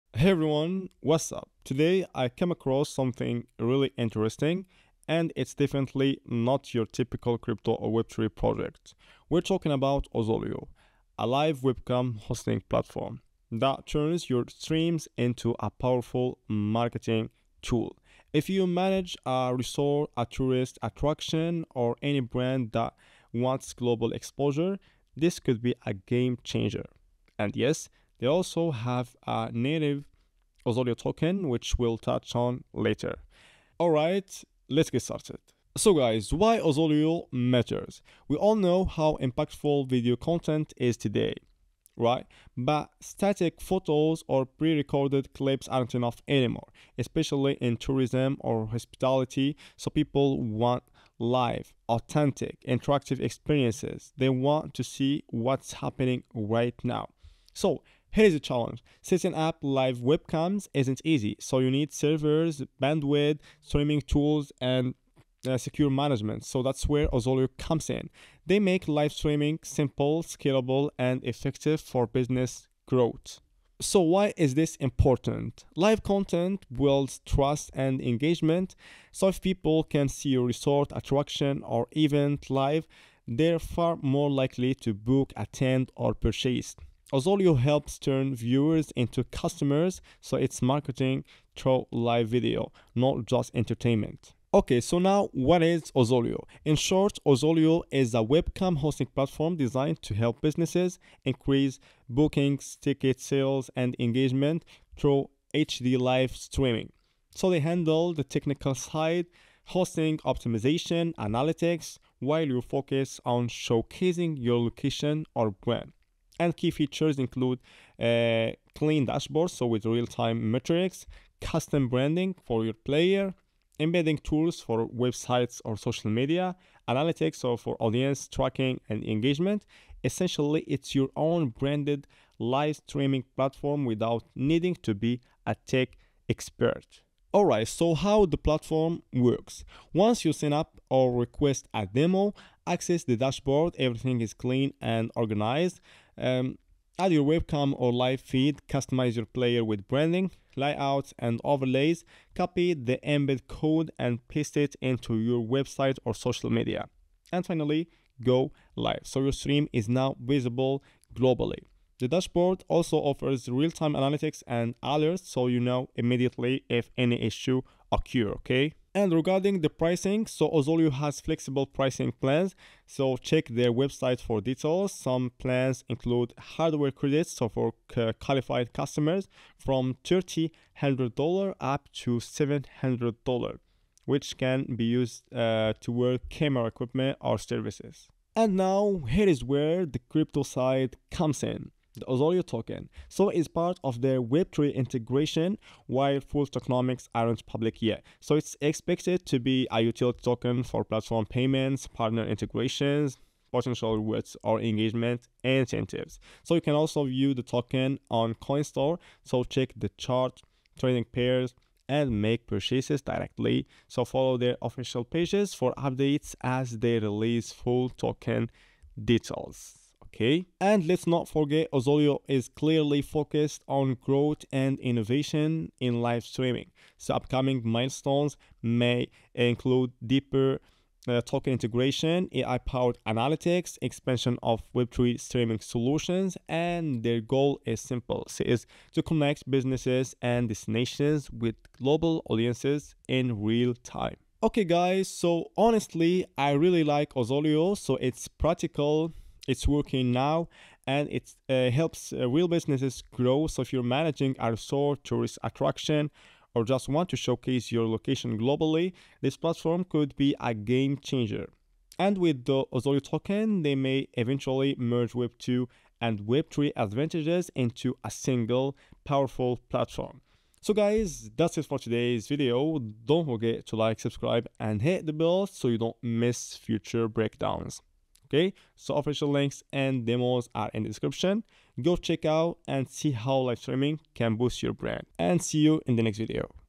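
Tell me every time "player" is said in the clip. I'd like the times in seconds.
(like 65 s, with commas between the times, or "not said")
122 s, 149 s.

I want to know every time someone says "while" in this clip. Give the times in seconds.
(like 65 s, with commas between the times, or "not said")
112 s, 195 s.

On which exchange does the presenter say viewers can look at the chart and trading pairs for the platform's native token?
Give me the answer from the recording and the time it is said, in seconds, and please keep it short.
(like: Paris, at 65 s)
CoinStore, at 208 s.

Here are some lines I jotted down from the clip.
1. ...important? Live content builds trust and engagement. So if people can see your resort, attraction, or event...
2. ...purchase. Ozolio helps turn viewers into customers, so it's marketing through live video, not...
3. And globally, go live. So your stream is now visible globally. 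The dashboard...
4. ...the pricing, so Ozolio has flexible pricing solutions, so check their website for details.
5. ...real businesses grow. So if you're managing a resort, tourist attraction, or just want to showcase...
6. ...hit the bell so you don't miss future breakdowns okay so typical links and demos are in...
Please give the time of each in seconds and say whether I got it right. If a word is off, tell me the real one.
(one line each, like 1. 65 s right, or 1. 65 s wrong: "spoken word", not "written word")
1. 74 s right
2. 86 s right
3. 157 s wrong: "finally", not "globally"
4. 169 s wrong: "plans", not "solutions"
5. 252 s right
6. 274 s wrong: "official", not "typical".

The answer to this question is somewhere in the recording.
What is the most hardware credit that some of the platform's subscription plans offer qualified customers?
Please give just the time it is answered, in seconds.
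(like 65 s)
182 s.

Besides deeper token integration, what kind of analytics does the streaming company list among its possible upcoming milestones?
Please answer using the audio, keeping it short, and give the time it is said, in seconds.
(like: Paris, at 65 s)
AI powered analytics, at 232 s.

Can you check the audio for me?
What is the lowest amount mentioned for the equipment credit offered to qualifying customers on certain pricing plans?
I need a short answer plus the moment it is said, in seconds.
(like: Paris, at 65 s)
$300, at 180 s.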